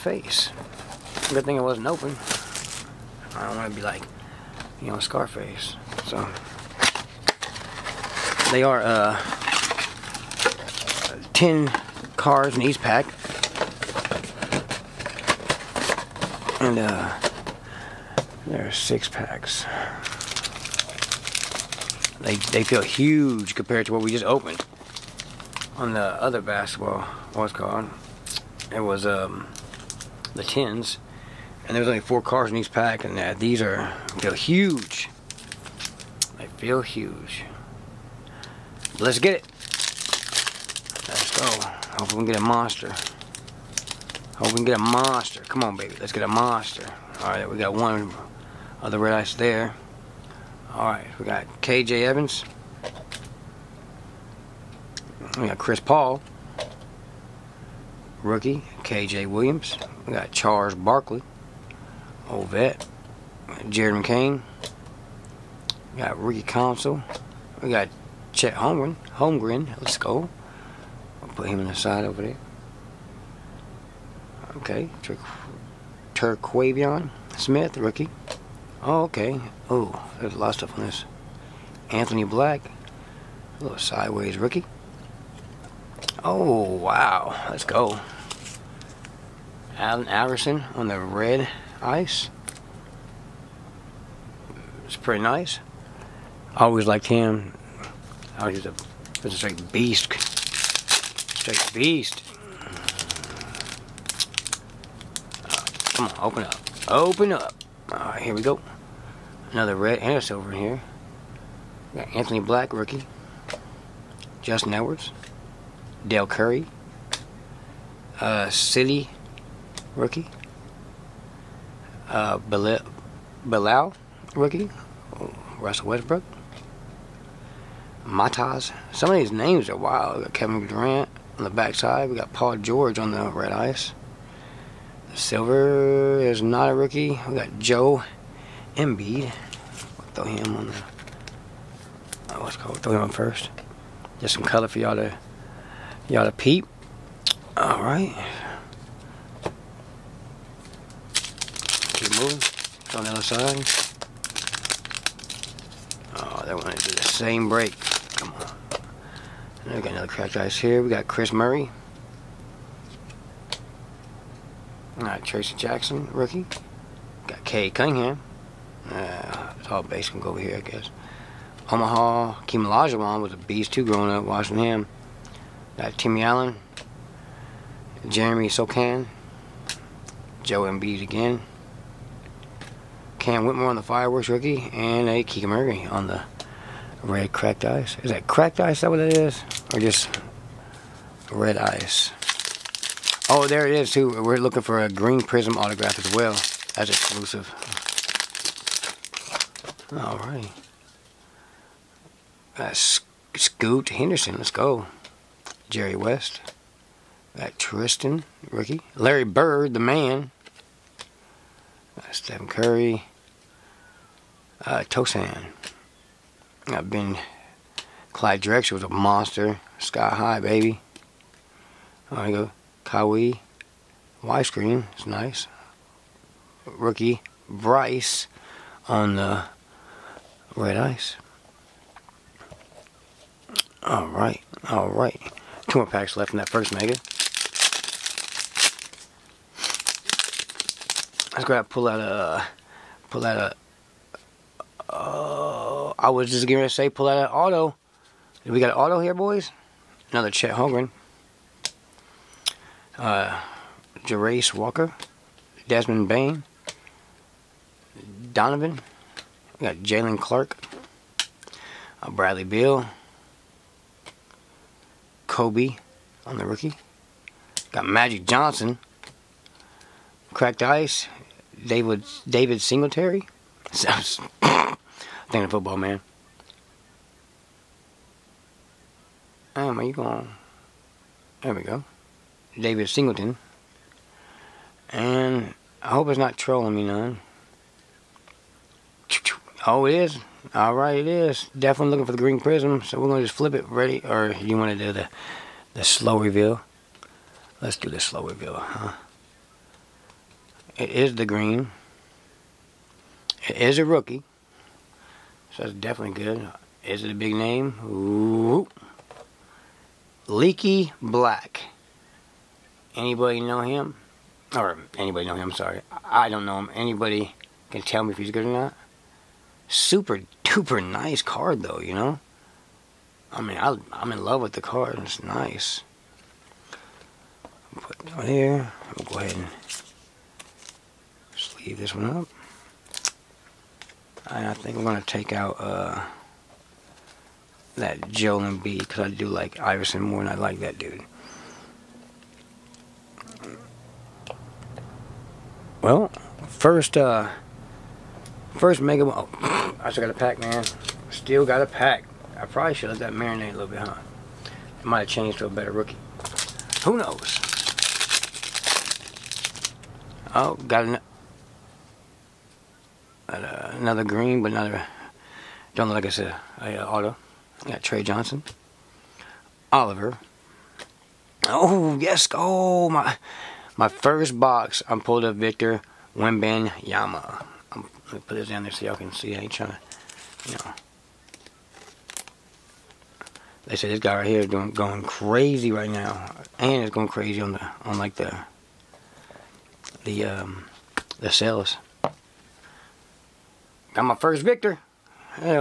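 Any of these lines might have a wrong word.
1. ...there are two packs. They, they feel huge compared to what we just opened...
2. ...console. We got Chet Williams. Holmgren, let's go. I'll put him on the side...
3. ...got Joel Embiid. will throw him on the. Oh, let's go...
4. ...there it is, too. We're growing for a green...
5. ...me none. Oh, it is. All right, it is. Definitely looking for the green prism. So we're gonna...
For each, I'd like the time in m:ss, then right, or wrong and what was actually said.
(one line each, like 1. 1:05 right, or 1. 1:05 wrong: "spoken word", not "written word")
1. 0:18 wrong: "six", not "two"
2. 1:06 wrong: "Holmgren", not "Williams"
3. 2:17 right
4. 3:13 wrong: "looking", not "growing"
5. 4:46 right.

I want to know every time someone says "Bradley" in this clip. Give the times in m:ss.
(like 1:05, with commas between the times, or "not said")
4:22.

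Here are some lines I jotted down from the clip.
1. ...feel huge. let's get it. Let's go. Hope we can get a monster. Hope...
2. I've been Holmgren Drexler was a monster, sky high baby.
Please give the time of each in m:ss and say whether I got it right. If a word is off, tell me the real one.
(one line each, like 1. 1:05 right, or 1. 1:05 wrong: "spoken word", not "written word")
1. 0:36 right
2. 3:36 wrong: "Clyde", not "Holmgren".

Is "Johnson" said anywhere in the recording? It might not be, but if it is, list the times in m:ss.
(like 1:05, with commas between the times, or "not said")
4:28, 6:08.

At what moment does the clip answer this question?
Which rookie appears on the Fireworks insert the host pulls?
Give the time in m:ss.
3:03.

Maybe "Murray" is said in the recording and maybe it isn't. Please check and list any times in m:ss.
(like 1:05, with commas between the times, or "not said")
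2:41, 3:05.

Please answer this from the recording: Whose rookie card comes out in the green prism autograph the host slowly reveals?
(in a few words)
Leaky Black.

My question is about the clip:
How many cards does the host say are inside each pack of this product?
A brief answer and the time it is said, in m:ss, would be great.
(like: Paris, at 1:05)
10, at 0:11.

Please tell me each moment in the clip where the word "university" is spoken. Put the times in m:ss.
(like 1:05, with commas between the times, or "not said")
not said.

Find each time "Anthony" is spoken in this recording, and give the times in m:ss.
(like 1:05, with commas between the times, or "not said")
1:21, 1:52.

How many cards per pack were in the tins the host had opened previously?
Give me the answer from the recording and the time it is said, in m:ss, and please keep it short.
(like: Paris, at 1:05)
4, at 0:32.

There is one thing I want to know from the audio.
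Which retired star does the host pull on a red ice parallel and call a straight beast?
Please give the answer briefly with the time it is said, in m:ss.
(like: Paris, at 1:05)
Allen Iverson, at 1:29.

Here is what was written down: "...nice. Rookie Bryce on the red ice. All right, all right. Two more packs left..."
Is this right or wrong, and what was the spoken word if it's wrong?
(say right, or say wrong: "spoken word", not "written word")
right.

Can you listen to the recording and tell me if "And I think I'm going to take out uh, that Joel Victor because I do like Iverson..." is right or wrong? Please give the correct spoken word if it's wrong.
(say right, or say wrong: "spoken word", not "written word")
wrong: "Embiid", not "Victor".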